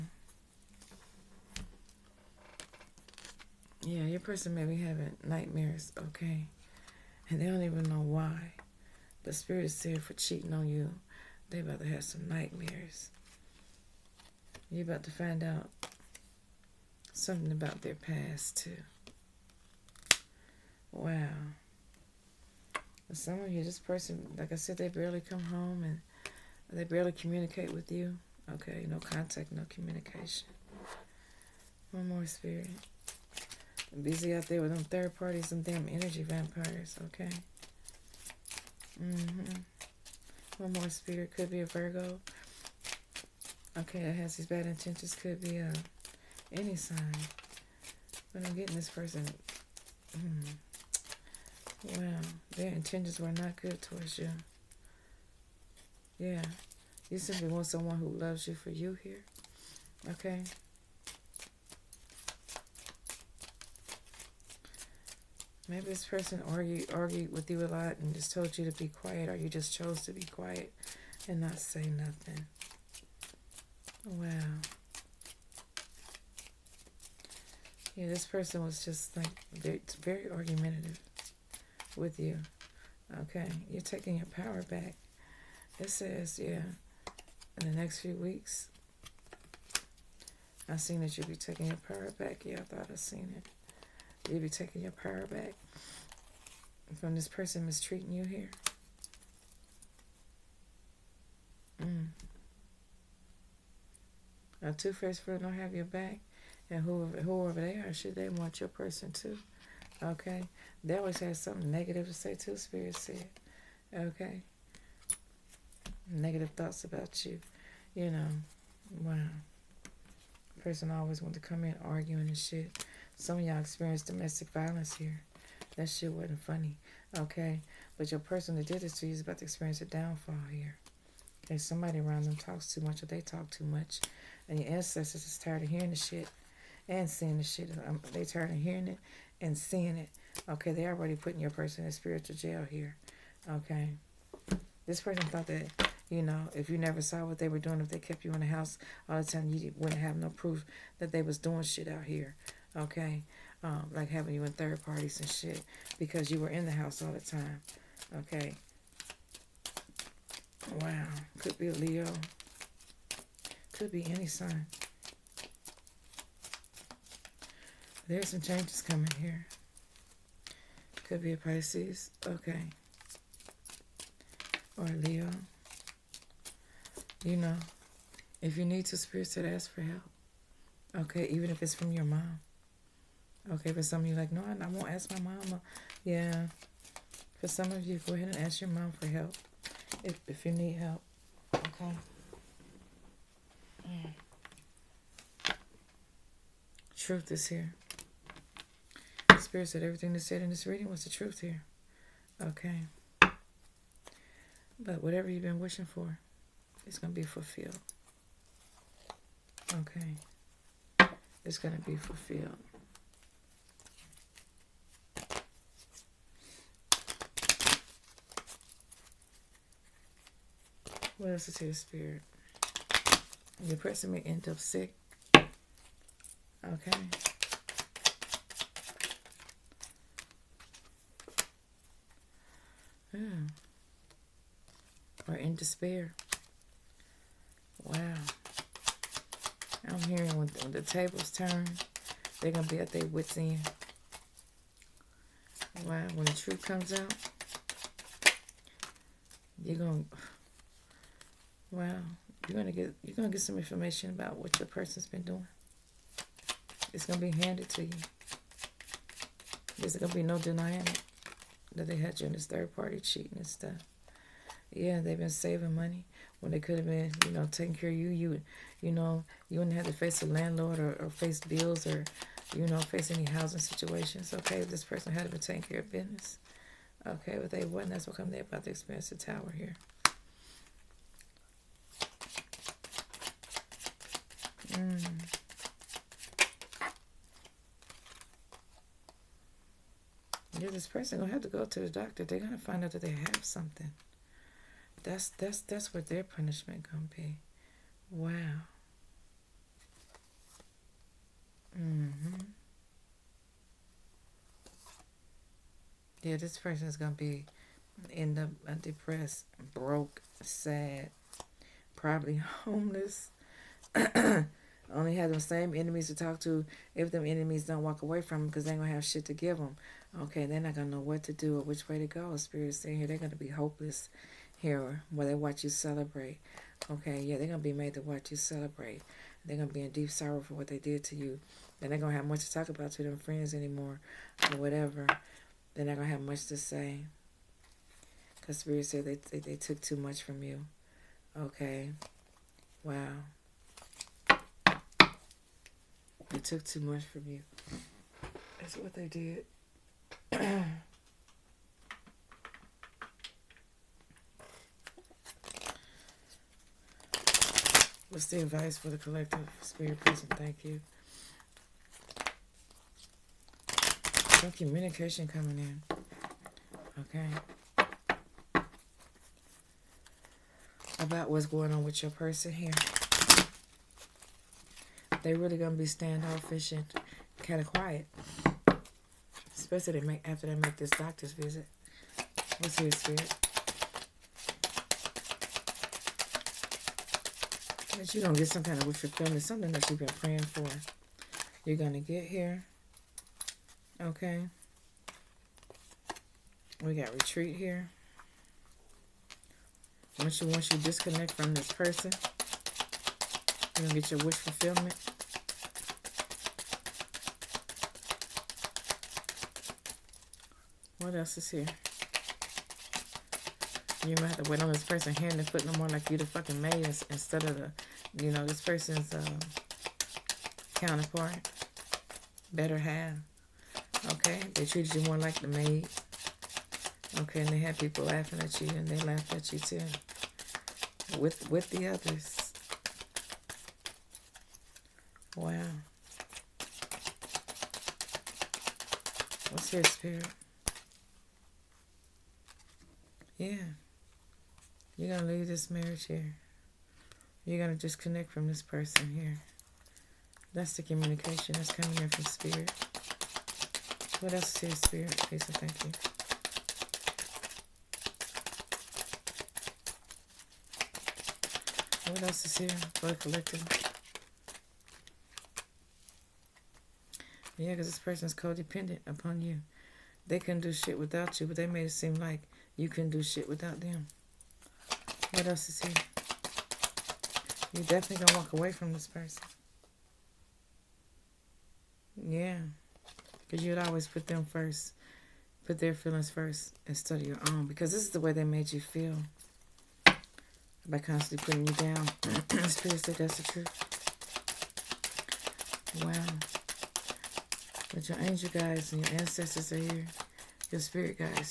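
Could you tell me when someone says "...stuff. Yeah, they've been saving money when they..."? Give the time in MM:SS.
04:23.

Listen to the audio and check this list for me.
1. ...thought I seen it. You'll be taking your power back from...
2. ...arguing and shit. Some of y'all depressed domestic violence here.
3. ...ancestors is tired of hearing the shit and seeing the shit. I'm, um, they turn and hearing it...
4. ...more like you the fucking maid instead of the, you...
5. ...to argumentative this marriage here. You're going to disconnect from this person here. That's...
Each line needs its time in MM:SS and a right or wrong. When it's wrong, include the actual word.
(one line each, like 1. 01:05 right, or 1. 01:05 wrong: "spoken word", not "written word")
1. 01:32 right
2. 02:01 wrong: "experienced", not "depressed"
3. 02:14 right
4. 06:55 right
5. 07:25 wrong: "leave", not "argumentative".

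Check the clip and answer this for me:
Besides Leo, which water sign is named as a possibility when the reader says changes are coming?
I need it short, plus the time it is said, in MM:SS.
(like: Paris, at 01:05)
Pisces, at 02:51.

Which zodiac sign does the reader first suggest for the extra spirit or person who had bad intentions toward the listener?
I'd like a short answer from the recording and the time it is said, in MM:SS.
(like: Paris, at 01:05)
Virgo, at 00:41.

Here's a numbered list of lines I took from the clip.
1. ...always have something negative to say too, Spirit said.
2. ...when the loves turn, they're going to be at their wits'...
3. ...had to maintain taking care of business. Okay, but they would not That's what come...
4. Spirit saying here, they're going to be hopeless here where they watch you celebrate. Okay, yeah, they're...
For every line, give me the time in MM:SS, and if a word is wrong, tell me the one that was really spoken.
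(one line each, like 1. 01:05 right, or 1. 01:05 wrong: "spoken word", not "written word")
1. 01:50 right
2. 04:00 wrong: "tables", not "loves"
3. 04:35 right
4. 05:22 right.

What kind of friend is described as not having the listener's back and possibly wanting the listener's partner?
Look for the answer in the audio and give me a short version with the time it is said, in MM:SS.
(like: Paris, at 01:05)
two-faced friend, at 01:44.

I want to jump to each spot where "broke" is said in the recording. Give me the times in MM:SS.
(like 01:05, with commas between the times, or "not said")
05:09.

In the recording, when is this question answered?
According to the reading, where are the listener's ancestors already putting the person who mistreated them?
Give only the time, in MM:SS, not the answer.
02:21.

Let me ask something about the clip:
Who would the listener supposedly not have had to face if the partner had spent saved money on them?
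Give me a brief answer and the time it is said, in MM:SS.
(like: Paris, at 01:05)
a landlord, at 04:30.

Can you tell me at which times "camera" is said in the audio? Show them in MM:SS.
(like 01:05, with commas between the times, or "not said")
not said.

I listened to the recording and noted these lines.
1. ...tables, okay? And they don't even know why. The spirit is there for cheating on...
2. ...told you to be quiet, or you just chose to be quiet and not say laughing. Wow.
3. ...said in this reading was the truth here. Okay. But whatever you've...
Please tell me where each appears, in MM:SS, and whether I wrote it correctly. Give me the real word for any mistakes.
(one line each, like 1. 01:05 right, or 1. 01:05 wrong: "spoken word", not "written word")
1. 00:05 wrong: "nightmares", not "tables"
2. 01:08 wrong: "nothing", not "laughing"
3. 03:20 right.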